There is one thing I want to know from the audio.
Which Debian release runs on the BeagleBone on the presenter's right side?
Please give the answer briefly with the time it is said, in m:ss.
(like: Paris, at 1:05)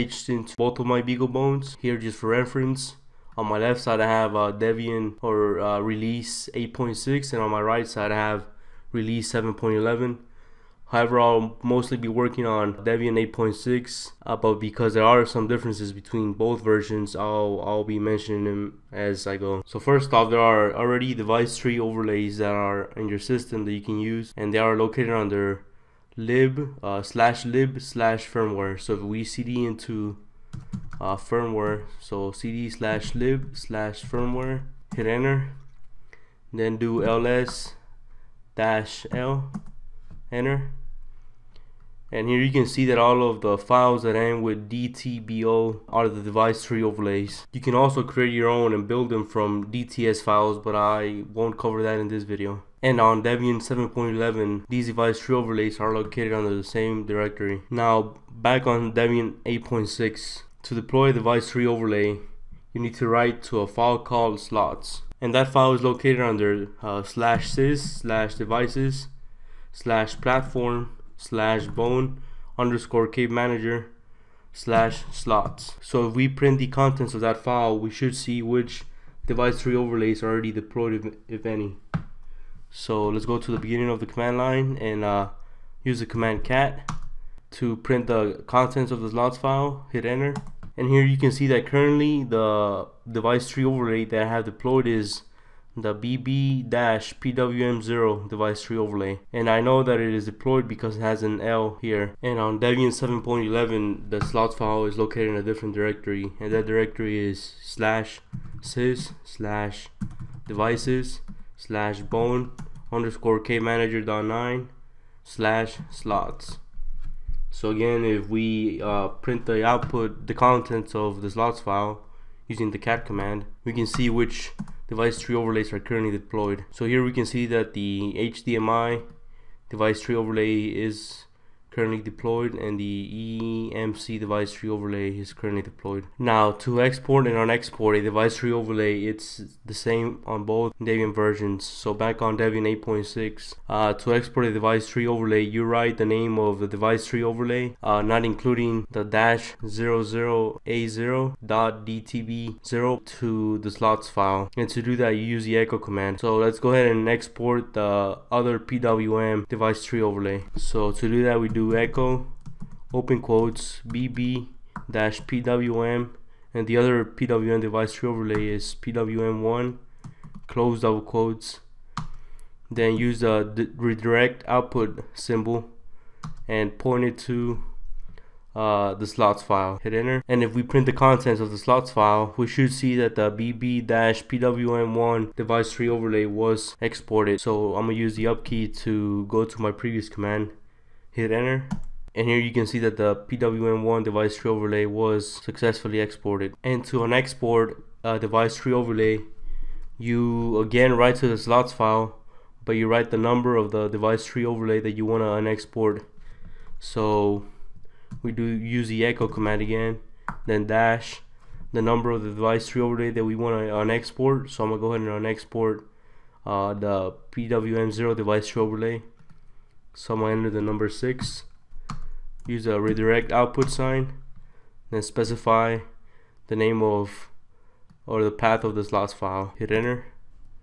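7.11, at 0:08.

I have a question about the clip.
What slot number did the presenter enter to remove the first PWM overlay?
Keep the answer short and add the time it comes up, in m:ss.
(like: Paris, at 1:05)
6, at 3:40.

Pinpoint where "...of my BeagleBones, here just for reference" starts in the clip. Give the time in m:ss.
0:00.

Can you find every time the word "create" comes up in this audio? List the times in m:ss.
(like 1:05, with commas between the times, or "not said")
0:48.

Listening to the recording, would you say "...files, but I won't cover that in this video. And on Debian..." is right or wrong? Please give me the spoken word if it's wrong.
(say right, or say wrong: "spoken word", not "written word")
right.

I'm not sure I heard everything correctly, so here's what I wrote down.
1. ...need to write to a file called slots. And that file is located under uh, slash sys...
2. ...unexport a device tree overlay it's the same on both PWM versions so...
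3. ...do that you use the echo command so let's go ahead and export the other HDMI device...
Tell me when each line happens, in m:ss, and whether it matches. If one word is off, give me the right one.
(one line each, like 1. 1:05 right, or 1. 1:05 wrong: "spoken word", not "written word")
1. 1:02 right
2. 2:17 wrong: "Debian", not "PWM"
3. 2:34 wrong: "PWM", not "HDMI".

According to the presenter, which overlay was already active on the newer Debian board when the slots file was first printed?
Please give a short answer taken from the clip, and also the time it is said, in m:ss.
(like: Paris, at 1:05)
BB-PWM0, at 1:35.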